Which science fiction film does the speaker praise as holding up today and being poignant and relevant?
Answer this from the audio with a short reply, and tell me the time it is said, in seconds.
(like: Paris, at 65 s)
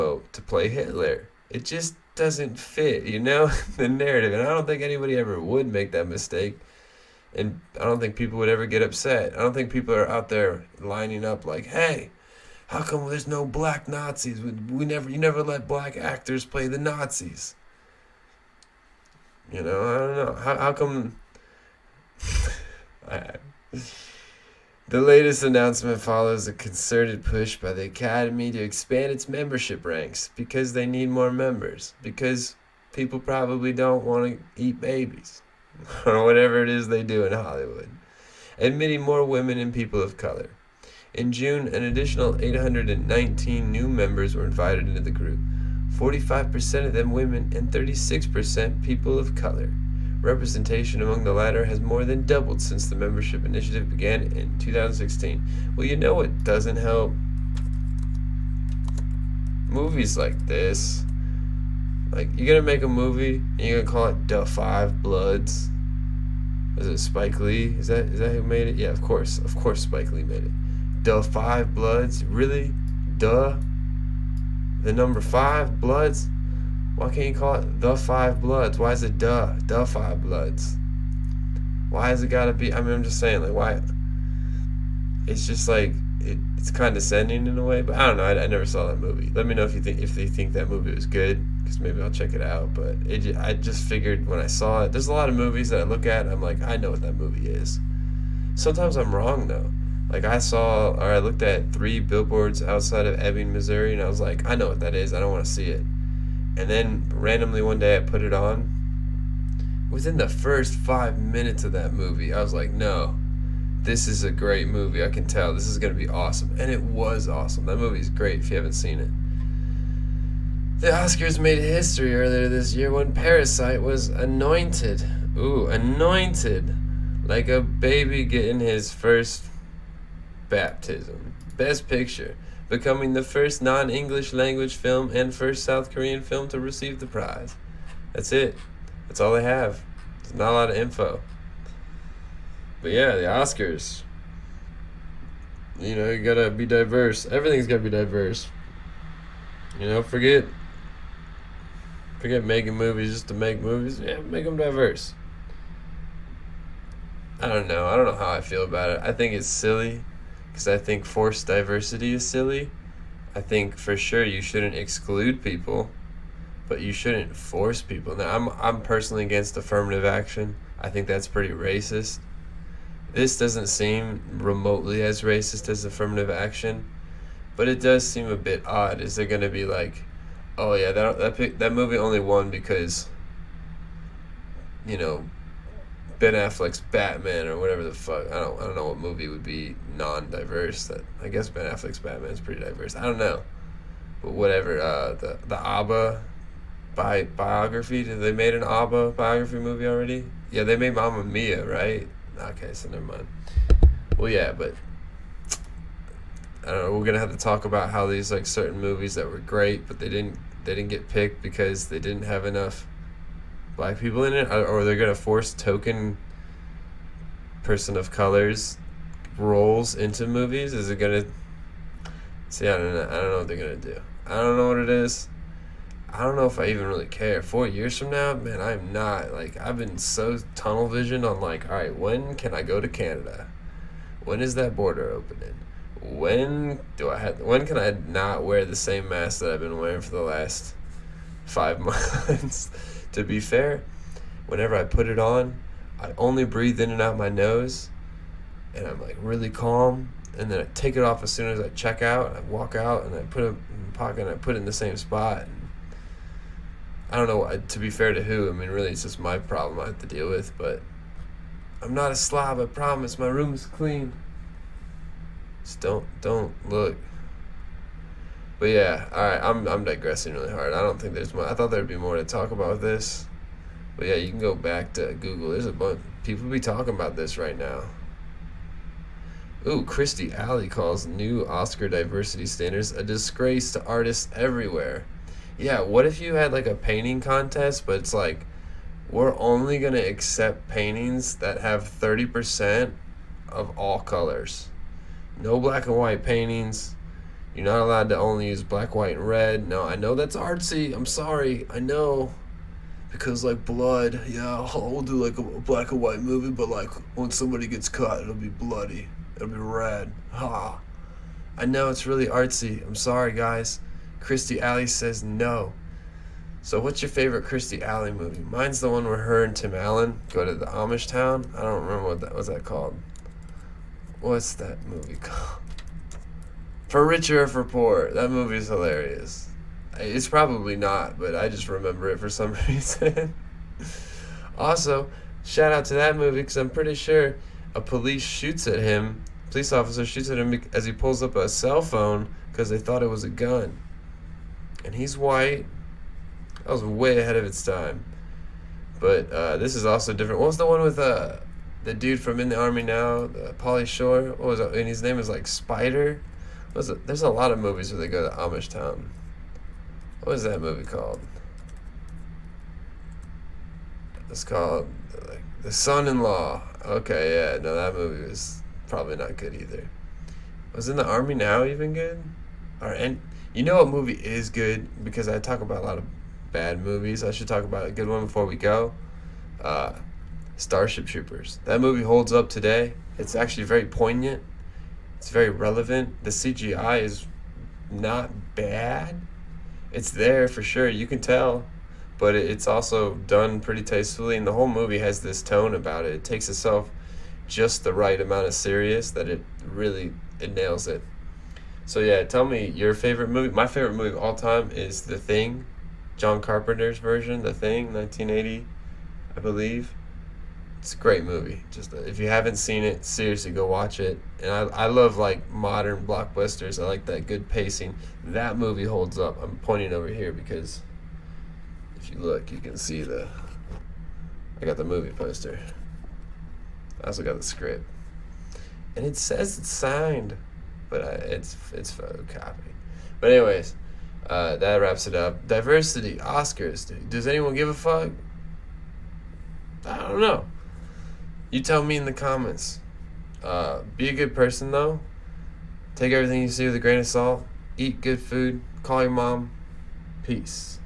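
Starship Troopers, at 380 s.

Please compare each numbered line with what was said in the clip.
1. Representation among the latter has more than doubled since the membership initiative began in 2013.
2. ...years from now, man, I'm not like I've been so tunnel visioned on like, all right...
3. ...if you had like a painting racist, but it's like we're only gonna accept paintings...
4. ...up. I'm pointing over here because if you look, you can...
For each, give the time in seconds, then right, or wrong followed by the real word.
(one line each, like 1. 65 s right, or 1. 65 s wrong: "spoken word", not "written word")
1. 50 s wrong: "2016", not "2013"
2. 227 s right
3. 286 s wrong: "contest", not "racist"
4. 419 s right.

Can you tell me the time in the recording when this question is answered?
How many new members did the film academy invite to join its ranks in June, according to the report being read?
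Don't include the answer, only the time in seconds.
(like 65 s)
42 s.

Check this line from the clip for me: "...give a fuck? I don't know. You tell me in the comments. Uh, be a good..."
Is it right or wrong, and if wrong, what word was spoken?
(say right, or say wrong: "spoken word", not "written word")
right.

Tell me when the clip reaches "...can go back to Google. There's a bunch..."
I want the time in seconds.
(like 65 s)
274 s.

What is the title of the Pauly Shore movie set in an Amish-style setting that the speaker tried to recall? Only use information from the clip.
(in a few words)
Son-in-Law.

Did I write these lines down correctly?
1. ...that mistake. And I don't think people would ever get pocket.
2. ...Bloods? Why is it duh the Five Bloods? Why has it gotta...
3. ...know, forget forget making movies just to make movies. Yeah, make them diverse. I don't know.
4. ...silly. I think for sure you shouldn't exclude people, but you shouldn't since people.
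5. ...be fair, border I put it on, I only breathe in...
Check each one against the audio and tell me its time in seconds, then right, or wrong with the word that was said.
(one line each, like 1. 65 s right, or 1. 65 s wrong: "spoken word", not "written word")
1. 5 s wrong: "upset", not "pocket"
2. 78 s right
3. 149 s right
4. 162 s wrong: "force", not "since"
5. 243 s wrong: "whenever", not "border".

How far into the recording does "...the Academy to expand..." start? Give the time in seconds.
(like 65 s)
27 s.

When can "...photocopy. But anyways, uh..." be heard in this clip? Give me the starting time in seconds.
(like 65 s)
431 s.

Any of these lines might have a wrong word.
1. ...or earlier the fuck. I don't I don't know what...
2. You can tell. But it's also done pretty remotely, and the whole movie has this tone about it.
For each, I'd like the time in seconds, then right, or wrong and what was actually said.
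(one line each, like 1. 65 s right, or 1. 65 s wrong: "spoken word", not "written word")
1. 187 s wrong: "whatever", not "earlier"
2. 390 s wrong: "tastefully", not "remotely".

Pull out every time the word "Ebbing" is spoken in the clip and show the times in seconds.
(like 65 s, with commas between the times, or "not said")
103 s.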